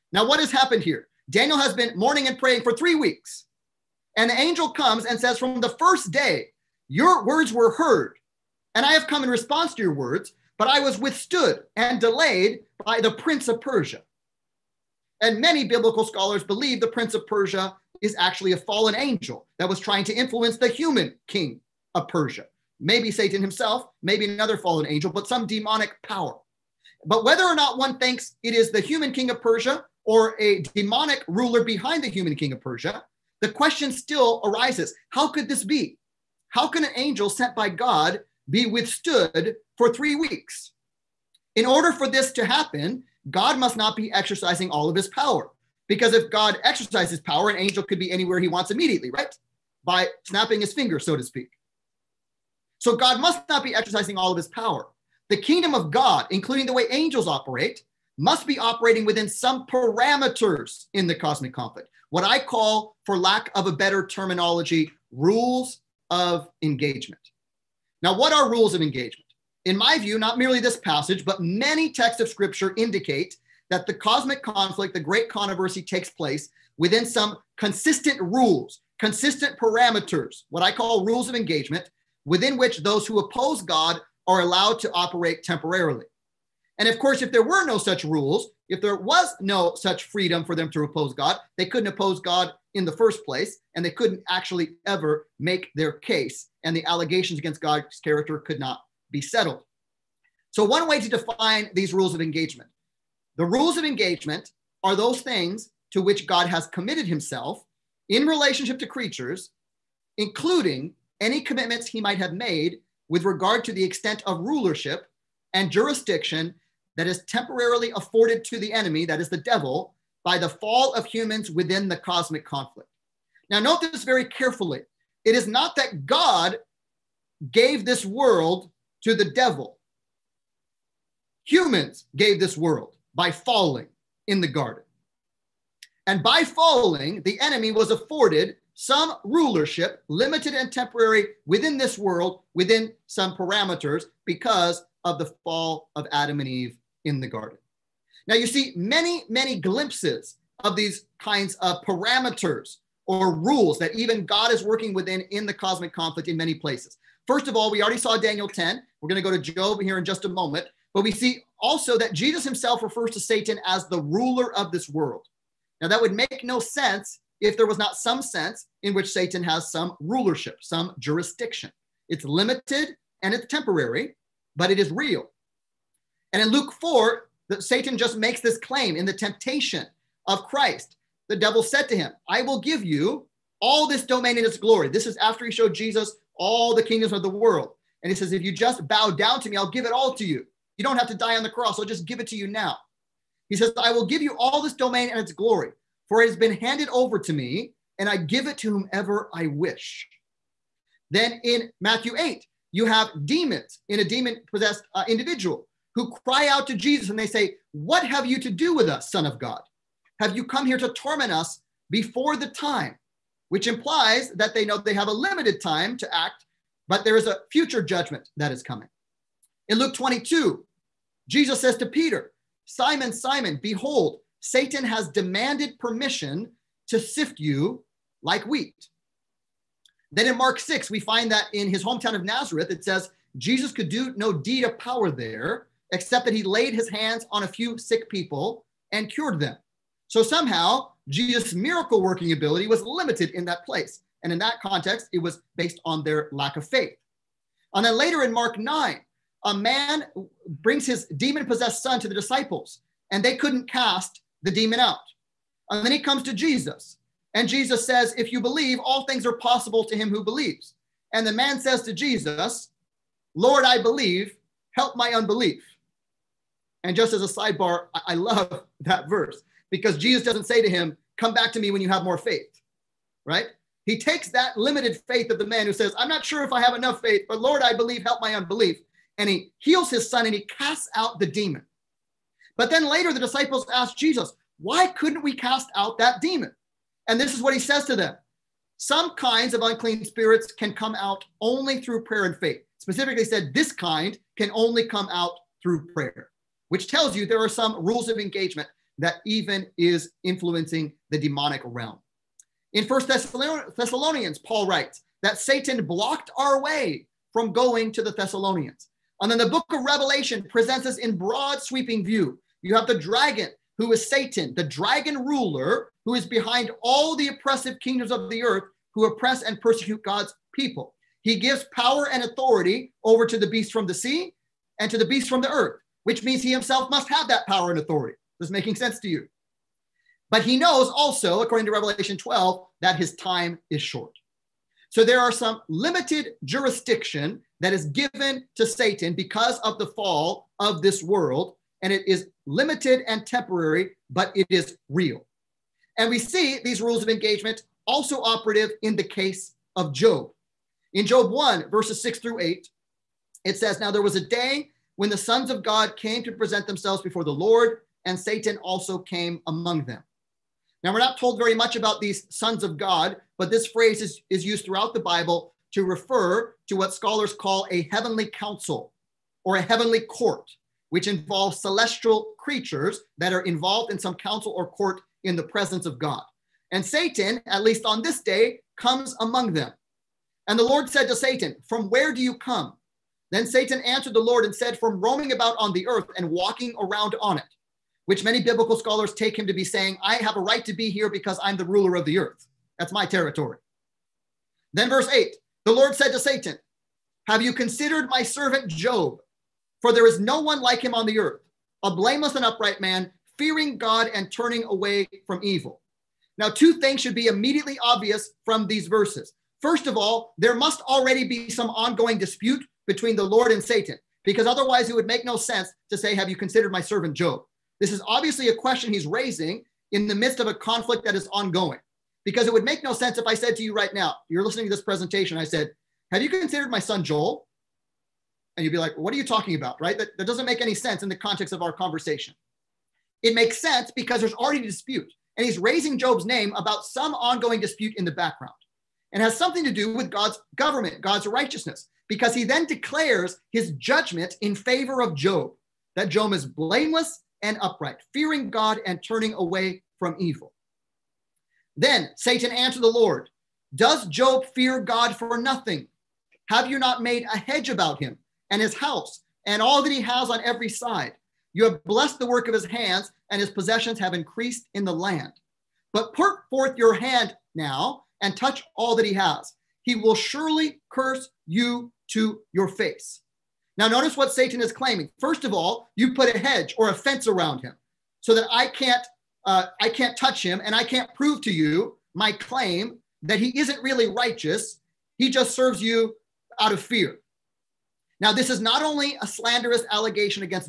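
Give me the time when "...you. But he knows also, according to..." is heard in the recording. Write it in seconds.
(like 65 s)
329 s.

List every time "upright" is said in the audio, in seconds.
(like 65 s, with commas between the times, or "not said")
402 s, 447 s.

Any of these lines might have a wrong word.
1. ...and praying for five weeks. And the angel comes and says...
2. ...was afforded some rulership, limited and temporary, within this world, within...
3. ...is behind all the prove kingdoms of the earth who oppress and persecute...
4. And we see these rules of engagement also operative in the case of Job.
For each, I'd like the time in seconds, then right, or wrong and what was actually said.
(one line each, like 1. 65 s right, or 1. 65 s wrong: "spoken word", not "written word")
1. 2 s wrong: "three", not "five"
2. 137 s right
3. 316 s wrong: "oppressive", not "prove"
4. 345 s right.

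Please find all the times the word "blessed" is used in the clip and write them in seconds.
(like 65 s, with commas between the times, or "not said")
461 s.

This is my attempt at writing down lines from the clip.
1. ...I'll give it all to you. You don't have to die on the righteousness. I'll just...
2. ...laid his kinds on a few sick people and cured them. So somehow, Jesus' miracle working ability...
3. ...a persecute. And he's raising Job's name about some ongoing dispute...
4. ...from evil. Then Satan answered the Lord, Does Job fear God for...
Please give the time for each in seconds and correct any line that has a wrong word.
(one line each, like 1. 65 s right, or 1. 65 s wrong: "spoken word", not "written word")
1. 189 s wrong: "cross", not "righteousness"
2. 236 s wrong: "hands", not "kinds"
3. 434 s wrong: "dispute", not "persecute"
4. 449 s right.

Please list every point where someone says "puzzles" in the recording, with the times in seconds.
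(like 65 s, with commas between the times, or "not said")
not said.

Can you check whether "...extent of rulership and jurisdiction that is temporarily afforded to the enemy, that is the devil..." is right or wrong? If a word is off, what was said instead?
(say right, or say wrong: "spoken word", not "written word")
right.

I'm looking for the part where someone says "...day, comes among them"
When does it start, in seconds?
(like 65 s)
378 s.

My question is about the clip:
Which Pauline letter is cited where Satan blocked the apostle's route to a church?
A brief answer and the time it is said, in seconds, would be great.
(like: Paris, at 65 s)
First Thessalonians, at 302 s.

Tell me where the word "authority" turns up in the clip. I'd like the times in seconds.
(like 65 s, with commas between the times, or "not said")
322 s, 327 s.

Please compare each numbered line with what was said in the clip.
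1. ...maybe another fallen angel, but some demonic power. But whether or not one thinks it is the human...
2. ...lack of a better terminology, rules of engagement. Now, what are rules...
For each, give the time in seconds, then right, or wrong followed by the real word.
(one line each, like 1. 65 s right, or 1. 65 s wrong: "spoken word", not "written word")
1. 24 s right
2. 63 s right.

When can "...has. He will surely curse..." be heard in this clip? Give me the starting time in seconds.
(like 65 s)
469 s.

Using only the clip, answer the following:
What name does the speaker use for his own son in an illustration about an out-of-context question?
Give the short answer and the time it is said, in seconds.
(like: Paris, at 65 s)
Joel, at 427 s.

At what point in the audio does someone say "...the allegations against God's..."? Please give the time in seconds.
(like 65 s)
96 s.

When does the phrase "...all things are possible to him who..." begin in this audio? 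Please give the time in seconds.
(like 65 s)
258 s.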